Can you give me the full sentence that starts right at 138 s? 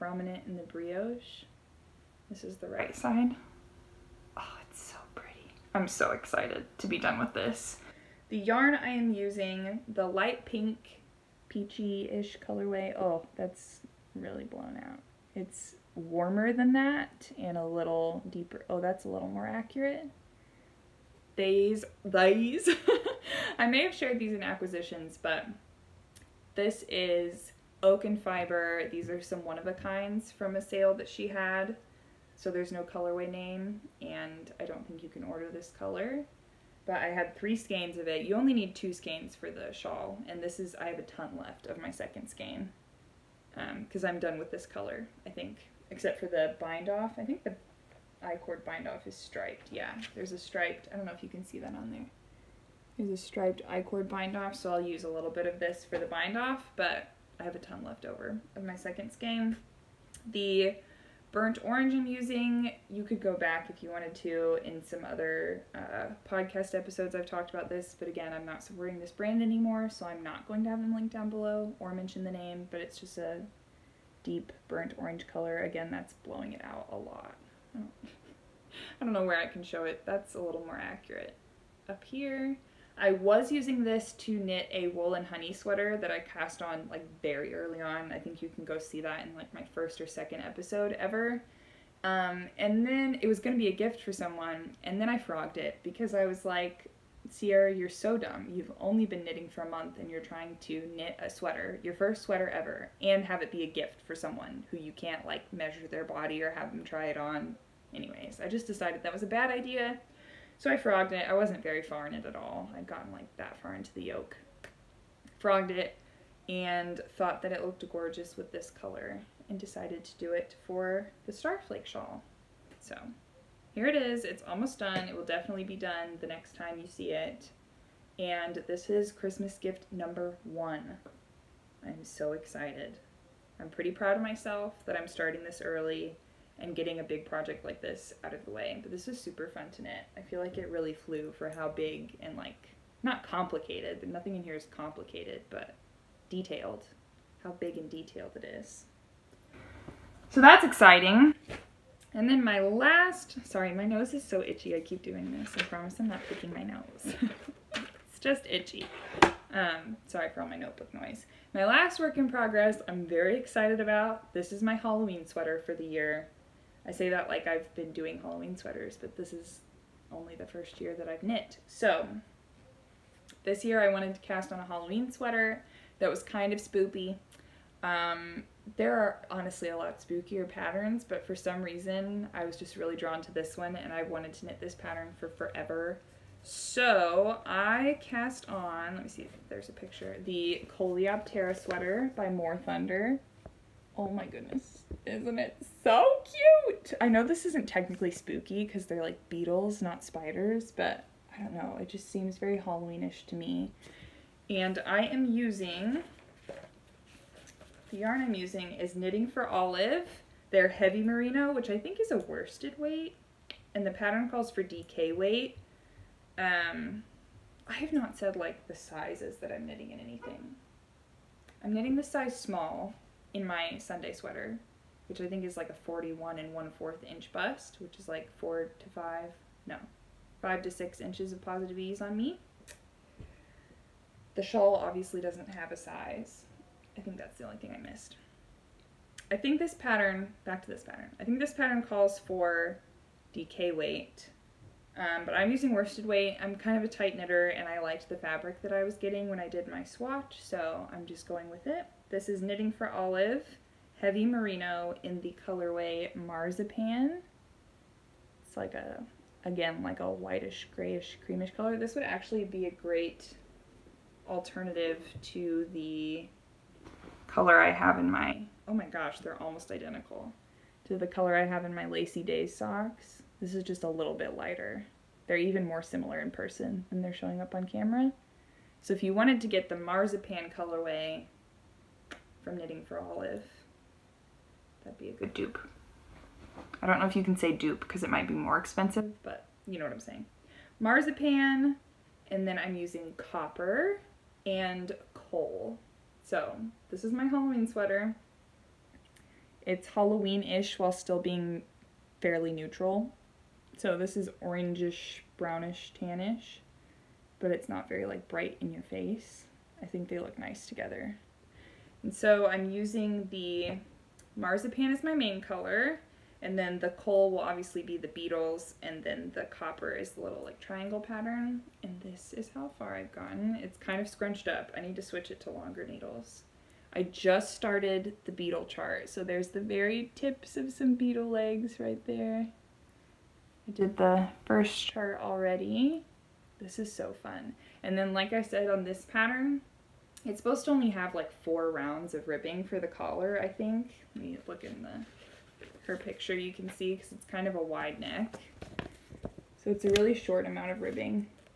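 But this was super fun to knit.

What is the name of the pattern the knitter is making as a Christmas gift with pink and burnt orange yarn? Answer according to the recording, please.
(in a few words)
Starflake shawl.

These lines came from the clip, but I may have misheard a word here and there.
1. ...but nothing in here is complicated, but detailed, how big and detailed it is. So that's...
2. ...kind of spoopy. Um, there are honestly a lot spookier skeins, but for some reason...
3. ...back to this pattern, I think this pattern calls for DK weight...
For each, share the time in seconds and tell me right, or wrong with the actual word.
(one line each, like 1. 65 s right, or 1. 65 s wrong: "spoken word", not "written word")
1. 144 s right
2. 176 s wrong: "patterns", not "skeins"
3. 240 s right.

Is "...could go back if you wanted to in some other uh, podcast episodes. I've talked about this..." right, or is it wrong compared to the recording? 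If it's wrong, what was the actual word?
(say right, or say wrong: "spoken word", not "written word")
right.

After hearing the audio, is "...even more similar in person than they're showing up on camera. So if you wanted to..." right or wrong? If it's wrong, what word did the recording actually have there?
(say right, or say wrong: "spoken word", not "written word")
right.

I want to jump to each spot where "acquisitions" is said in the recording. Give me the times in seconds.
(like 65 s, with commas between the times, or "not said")
24 s.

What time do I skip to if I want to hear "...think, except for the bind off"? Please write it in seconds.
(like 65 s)
45 s.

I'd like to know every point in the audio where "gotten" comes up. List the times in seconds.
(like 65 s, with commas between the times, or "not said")
112 s, 323 s.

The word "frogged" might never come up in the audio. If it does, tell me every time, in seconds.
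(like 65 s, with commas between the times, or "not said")
95 s, 110 s, 115 s.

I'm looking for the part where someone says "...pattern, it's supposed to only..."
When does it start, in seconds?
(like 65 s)
339 s.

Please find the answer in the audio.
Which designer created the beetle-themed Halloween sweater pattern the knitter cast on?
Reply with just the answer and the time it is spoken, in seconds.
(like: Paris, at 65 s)
More Thunder, at 192 s.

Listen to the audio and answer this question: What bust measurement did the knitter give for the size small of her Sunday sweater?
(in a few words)
41 1/4 inches.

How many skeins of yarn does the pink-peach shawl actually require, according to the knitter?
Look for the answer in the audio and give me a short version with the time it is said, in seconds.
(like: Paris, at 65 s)
2, at 38 s.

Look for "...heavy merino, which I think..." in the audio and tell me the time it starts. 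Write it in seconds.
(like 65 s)
210 s.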